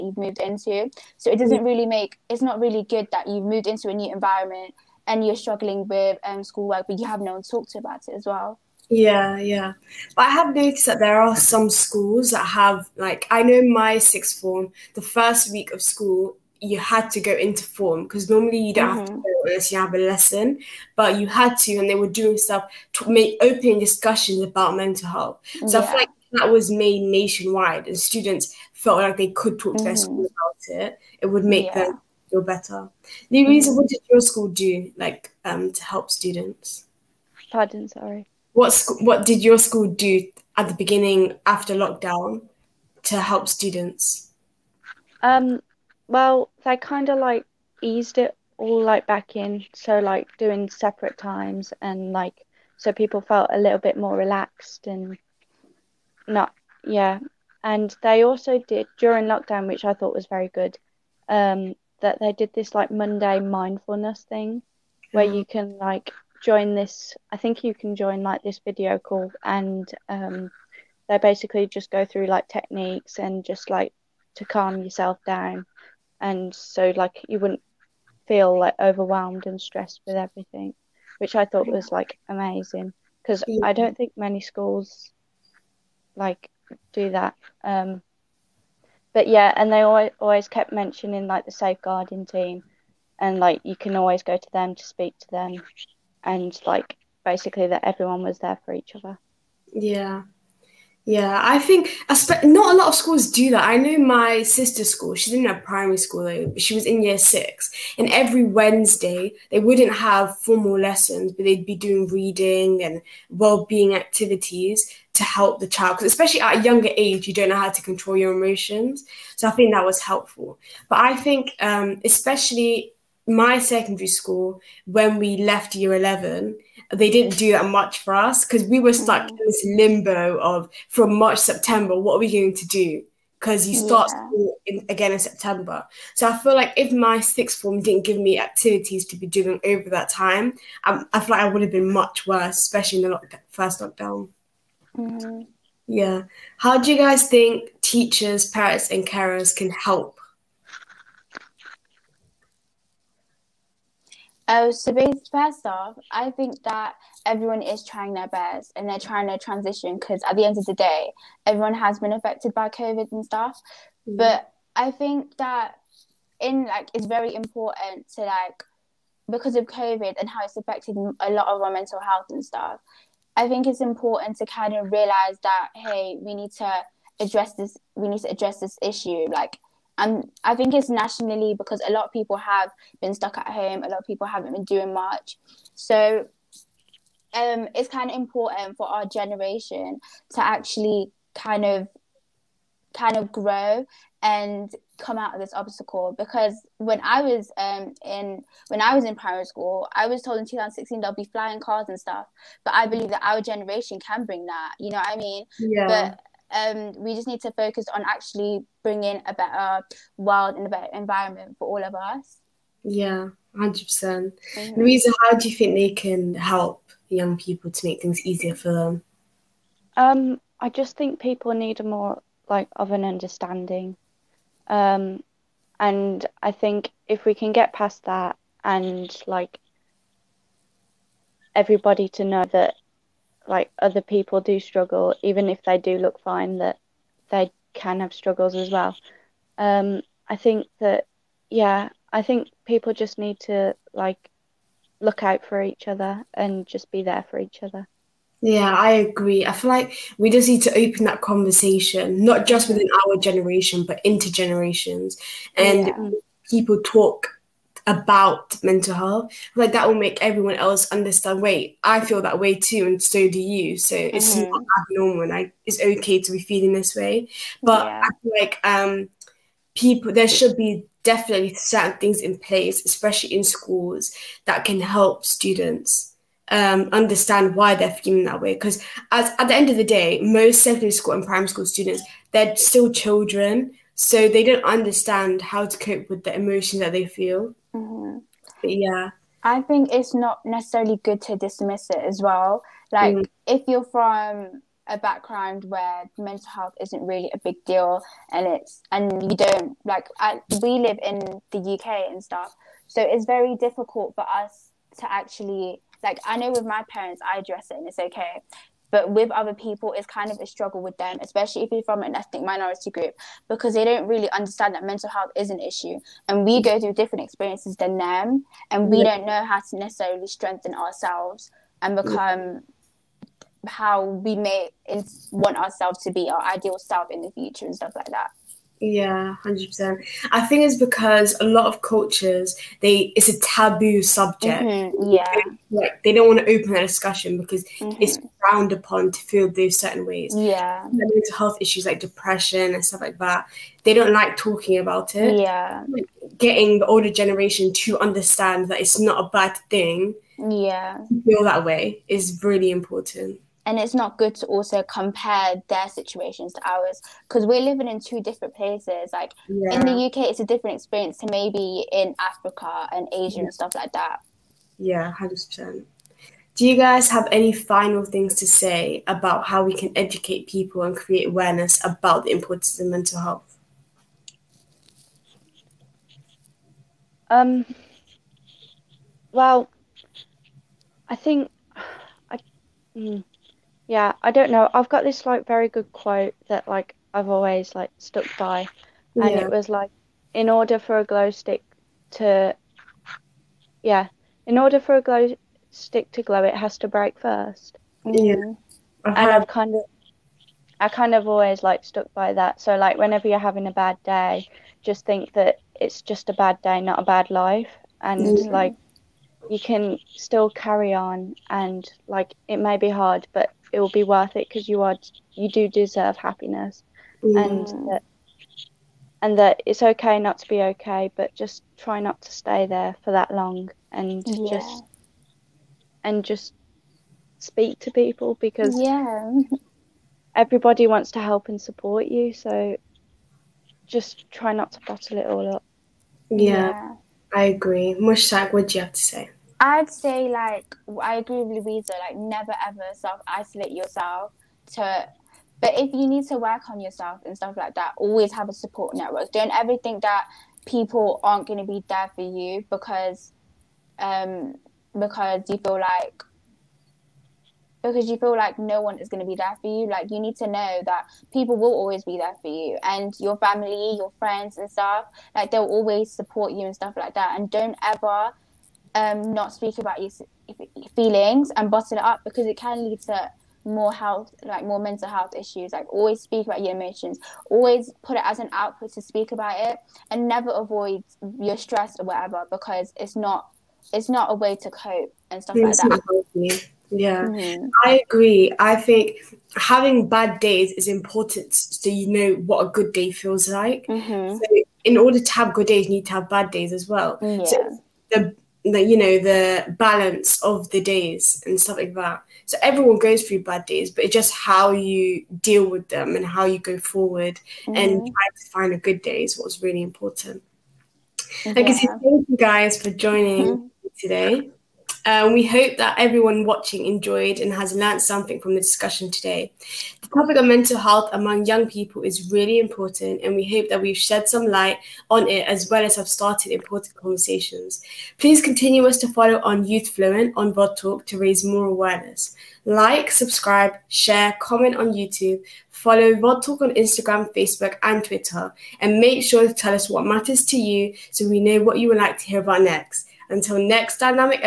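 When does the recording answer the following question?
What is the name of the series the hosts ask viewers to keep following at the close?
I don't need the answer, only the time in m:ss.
8:49.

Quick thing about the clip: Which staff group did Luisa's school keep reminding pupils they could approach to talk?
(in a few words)
safeguarding team.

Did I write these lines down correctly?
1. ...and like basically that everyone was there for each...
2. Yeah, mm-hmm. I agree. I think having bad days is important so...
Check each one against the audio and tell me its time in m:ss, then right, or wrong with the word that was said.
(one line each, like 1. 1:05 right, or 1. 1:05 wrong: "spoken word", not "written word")
1. 1:36 right
2. 8:06 right.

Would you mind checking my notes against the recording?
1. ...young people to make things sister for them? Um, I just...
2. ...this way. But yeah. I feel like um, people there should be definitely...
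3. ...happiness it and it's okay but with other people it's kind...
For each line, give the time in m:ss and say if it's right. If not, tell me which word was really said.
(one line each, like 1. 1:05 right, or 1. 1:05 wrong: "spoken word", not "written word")
1. 3:37 wrong: "easier", not "sister"
2. 4:26 right
3. 5:07 wrong: "address", not "happiness".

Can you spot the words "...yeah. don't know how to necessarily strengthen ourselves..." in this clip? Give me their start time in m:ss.
5:18.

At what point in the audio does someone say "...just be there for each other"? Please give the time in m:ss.
4:06.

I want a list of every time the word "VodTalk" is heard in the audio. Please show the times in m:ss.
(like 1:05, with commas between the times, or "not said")
8:50, 8:56.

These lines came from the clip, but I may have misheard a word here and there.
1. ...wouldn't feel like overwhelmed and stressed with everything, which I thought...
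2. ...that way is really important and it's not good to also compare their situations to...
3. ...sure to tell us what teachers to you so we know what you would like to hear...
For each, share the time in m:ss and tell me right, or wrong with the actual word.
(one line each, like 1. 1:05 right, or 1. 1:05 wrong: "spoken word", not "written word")
1. 1:17 right
2. 5:51 right
3. 8:59 wrong: "matters", not "teachers".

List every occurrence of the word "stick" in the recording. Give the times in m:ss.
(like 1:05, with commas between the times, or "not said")
6:31, 6:35.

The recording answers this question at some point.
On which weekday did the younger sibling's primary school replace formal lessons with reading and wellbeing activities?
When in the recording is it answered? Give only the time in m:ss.
1:48.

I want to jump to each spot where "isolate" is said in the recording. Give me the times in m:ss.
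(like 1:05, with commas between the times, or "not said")
7:23.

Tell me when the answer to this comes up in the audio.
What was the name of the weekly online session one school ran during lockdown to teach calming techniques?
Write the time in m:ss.
1:02.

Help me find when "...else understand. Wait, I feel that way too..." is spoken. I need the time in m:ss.
4:20.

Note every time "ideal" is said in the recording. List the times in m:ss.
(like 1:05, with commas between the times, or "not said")
5:26.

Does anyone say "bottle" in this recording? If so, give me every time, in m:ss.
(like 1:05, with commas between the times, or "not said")
7:14, 7:51.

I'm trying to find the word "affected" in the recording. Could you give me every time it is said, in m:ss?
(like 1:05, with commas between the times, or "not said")
2:42, 2:50.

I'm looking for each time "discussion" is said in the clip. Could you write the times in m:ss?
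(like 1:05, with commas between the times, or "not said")
0:23, 5:36, 8:38.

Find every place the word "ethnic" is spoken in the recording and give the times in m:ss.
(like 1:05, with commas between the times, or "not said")
5:12.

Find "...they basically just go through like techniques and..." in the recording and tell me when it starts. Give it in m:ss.
1:11.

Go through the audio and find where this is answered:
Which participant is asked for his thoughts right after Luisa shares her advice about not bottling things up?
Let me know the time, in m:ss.
7:17.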